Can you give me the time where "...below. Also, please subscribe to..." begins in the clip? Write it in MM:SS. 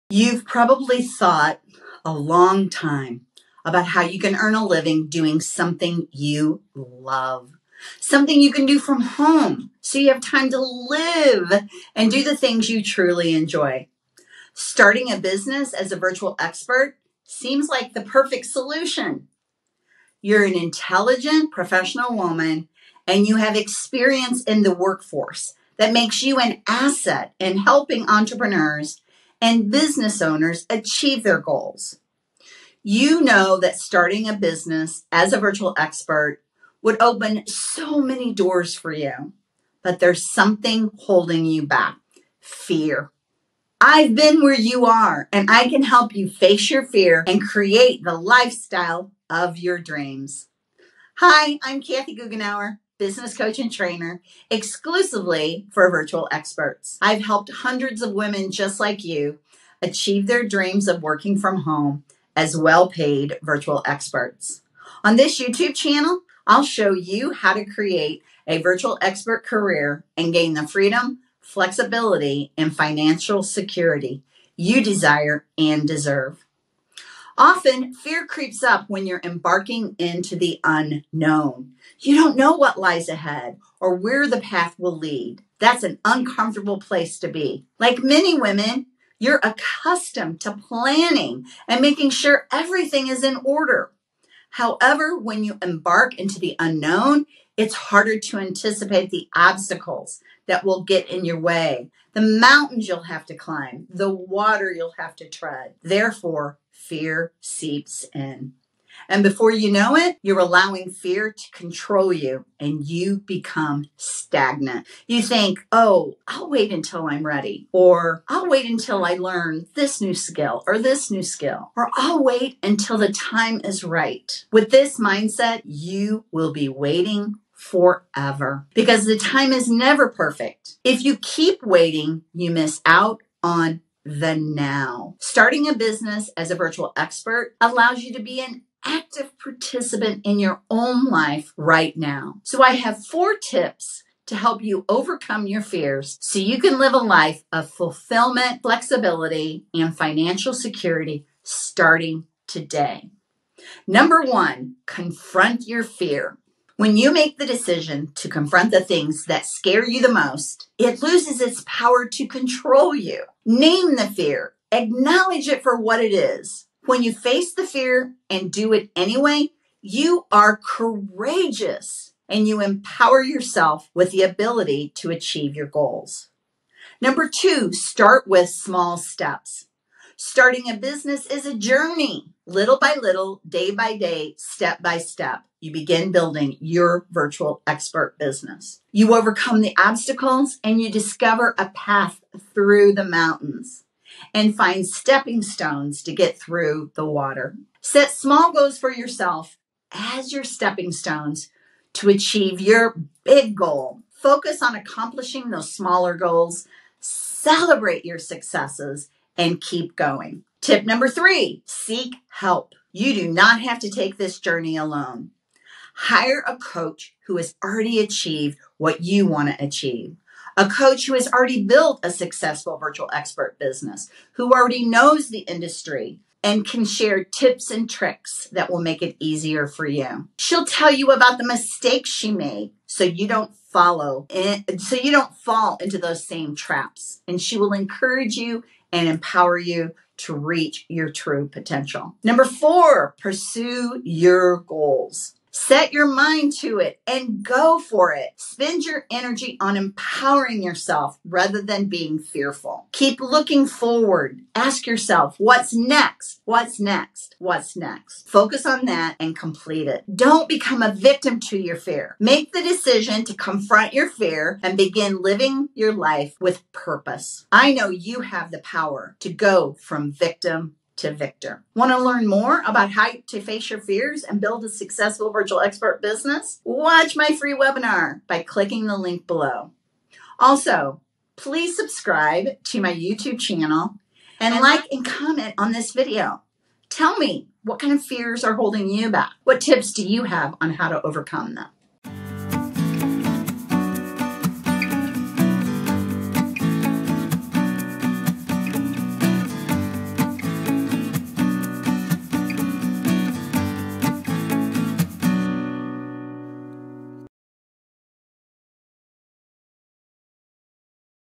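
04:39.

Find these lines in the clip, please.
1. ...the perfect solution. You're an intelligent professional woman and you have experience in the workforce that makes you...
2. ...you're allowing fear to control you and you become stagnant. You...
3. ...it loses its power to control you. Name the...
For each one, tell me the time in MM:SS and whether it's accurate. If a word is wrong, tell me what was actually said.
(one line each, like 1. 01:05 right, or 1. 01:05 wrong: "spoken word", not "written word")
1. 00:17 right
2. 01:50 right
3. 02:40 right.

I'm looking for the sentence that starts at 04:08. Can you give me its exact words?
Spend your energy on empowering yourself rather than being fearful.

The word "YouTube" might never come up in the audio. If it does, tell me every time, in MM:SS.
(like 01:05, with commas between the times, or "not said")
01:05, 04:42.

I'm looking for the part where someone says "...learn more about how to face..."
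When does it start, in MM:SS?
04:31.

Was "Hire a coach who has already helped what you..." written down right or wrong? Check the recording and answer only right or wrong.
wrong.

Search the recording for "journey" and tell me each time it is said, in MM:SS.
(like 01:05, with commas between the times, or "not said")
03:01, 03:34.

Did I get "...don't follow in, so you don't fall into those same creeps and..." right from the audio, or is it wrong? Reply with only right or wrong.
wrong.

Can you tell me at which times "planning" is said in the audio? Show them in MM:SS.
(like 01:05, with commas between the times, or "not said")
01:30.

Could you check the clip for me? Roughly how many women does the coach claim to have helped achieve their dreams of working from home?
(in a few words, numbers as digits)
hundreds.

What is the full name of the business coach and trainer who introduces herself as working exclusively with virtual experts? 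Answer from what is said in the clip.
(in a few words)
Kathy Goughenour.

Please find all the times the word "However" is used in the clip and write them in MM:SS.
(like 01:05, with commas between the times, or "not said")
01:34.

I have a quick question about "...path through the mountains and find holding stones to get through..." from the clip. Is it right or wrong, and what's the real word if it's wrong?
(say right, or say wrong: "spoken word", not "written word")
wrong: "stepping", not "holding".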